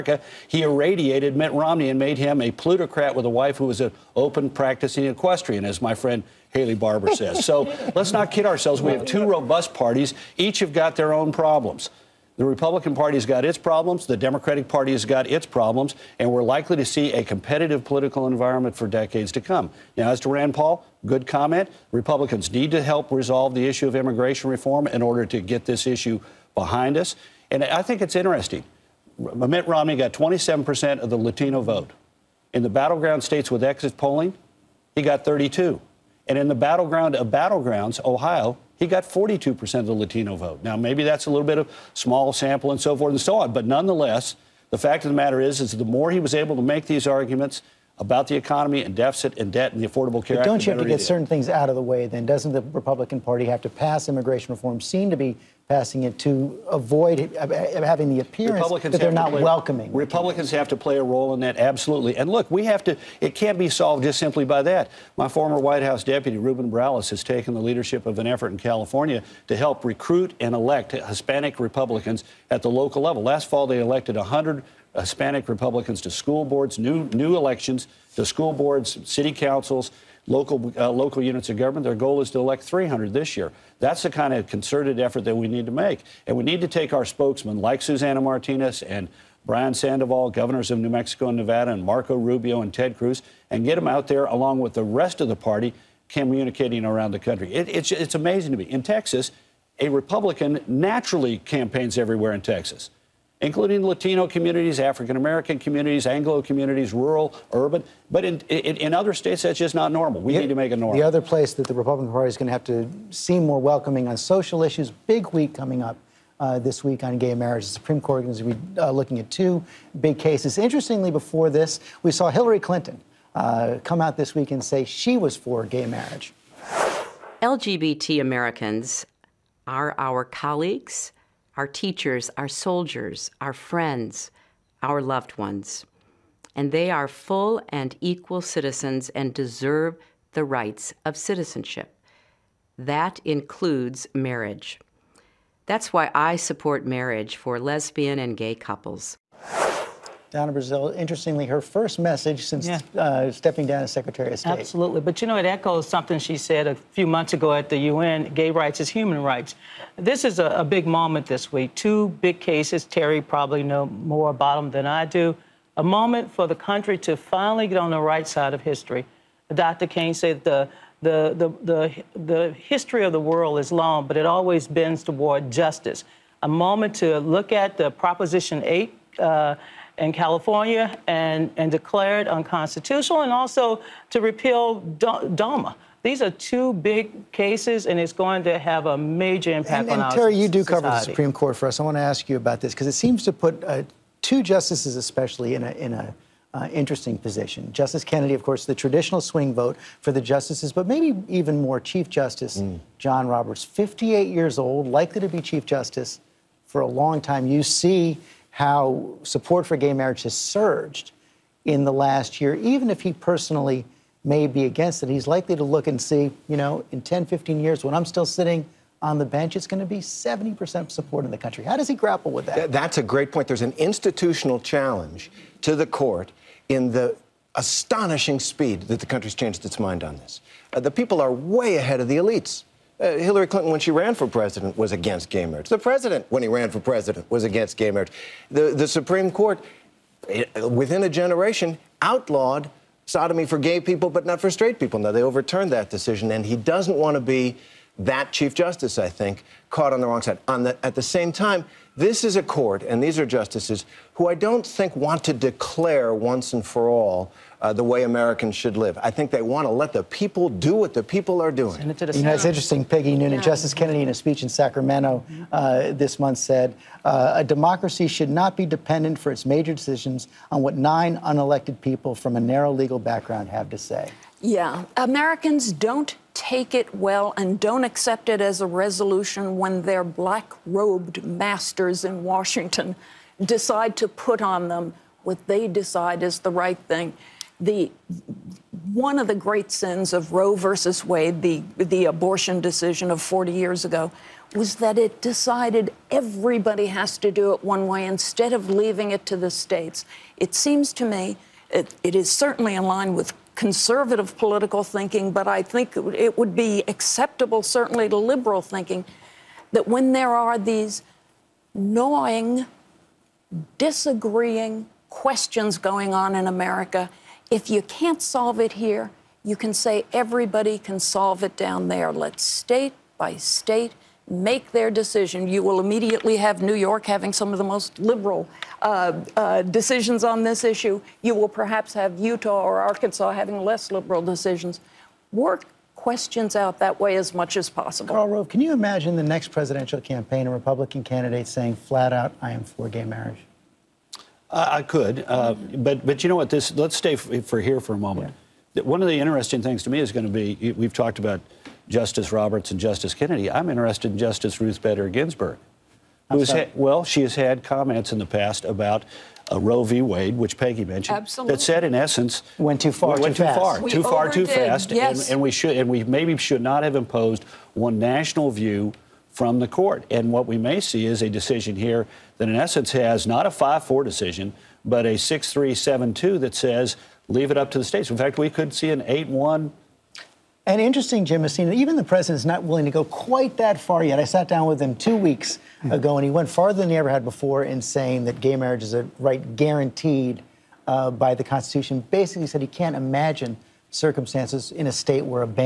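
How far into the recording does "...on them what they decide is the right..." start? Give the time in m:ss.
4:44.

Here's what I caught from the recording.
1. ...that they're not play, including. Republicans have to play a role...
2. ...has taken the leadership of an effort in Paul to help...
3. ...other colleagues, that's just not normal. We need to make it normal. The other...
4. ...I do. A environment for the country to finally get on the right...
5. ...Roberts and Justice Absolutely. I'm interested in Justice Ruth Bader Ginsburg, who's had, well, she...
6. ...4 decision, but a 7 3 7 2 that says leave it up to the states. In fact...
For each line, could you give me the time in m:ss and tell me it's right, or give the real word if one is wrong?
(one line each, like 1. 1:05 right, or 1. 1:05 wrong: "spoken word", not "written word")
1. 0:58 wrong: "welcoming", not "including"
2. 1:07 wrong: "California", not "Paul"
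3. 1:48 wrong: "states", not "colleagues"
4. 2:44 wrong: "moment", not "environment"
5. 5:52 wrong: "Kennedy", not "Absolutely"
6. 6:13 wrong: "6", not "7".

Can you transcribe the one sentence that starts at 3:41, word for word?
How does he grapple with that?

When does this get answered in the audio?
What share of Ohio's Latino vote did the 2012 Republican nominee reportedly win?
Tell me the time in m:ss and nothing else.
0:39.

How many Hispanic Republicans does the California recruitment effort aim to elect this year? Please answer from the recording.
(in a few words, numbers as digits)
300.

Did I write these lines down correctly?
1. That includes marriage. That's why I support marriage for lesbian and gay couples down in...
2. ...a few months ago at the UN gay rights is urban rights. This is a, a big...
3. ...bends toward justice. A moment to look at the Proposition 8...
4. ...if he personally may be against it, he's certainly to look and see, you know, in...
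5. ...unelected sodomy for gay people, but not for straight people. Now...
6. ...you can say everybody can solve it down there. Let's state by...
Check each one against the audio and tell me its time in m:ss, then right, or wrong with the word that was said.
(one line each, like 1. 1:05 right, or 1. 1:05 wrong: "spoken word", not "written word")
1. 2:22 right
2. 2:36 wrong: "human", not "urban"
3. 2:54 right
4. 3:32 wrong: "likely", not "certainly"
5. 4:02 wrong: "outlawed", not "unelected"
6. 5:19 right.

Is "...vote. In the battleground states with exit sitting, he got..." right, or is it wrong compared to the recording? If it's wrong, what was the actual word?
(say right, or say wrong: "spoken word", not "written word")
wrong: "polling", not "sitting".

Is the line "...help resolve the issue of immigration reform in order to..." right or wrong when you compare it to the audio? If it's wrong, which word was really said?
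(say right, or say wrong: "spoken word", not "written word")
right.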